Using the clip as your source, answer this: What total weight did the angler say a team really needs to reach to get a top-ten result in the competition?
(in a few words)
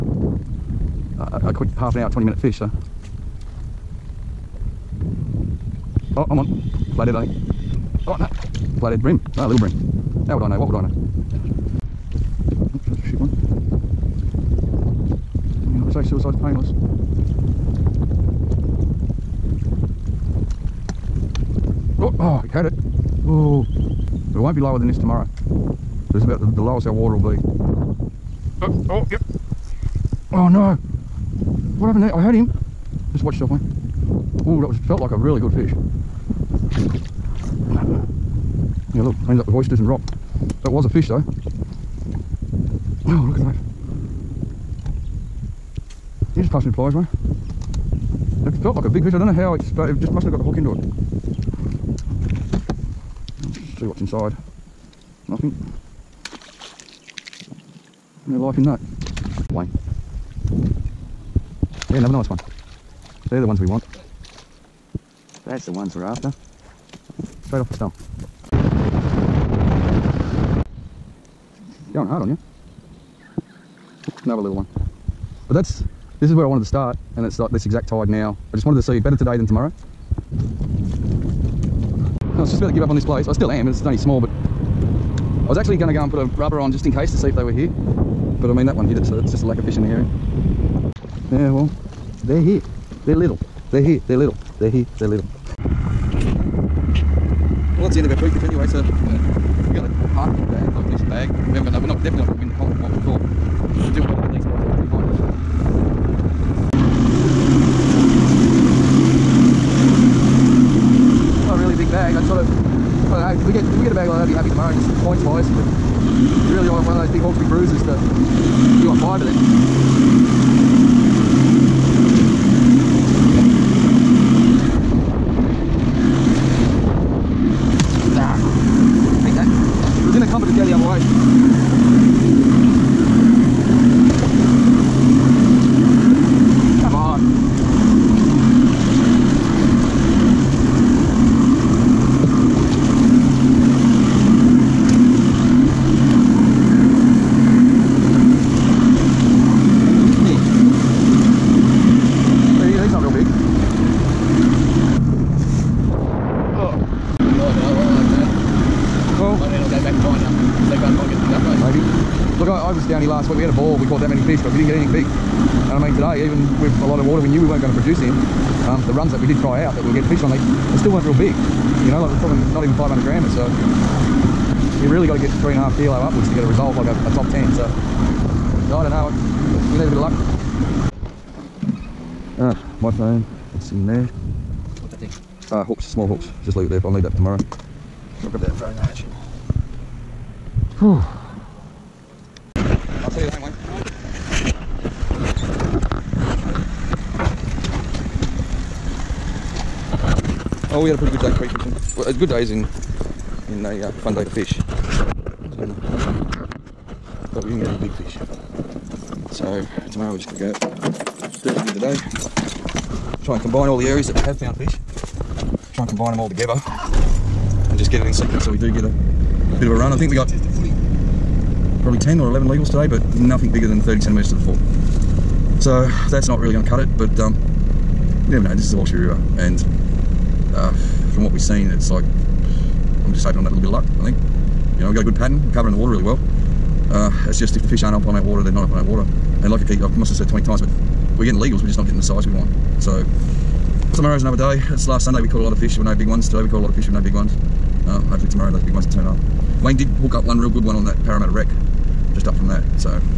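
3.5 kilos.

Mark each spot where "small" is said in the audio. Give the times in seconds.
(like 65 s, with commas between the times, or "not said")
83 s, 185 s.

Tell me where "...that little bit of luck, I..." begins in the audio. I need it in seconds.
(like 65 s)
233 s.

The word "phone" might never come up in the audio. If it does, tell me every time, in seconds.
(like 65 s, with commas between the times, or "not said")
182 s, 188 s.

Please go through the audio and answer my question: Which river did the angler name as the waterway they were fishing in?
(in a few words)
Hawkesbury River.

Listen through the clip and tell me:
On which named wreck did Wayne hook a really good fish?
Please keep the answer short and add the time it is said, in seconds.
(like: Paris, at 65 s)
Parramatta wreck, at 251 s.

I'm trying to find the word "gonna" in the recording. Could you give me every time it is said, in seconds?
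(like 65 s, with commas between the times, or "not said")
85 s, 210 s.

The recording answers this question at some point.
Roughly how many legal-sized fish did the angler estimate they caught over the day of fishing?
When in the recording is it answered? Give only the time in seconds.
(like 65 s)
221 s.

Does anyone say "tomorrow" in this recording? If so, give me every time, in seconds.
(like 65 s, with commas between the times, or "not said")
24 s, 79 s, 187 s, 209 s, 243 s, 248 s.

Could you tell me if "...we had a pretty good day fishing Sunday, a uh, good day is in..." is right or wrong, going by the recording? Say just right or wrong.
wrong.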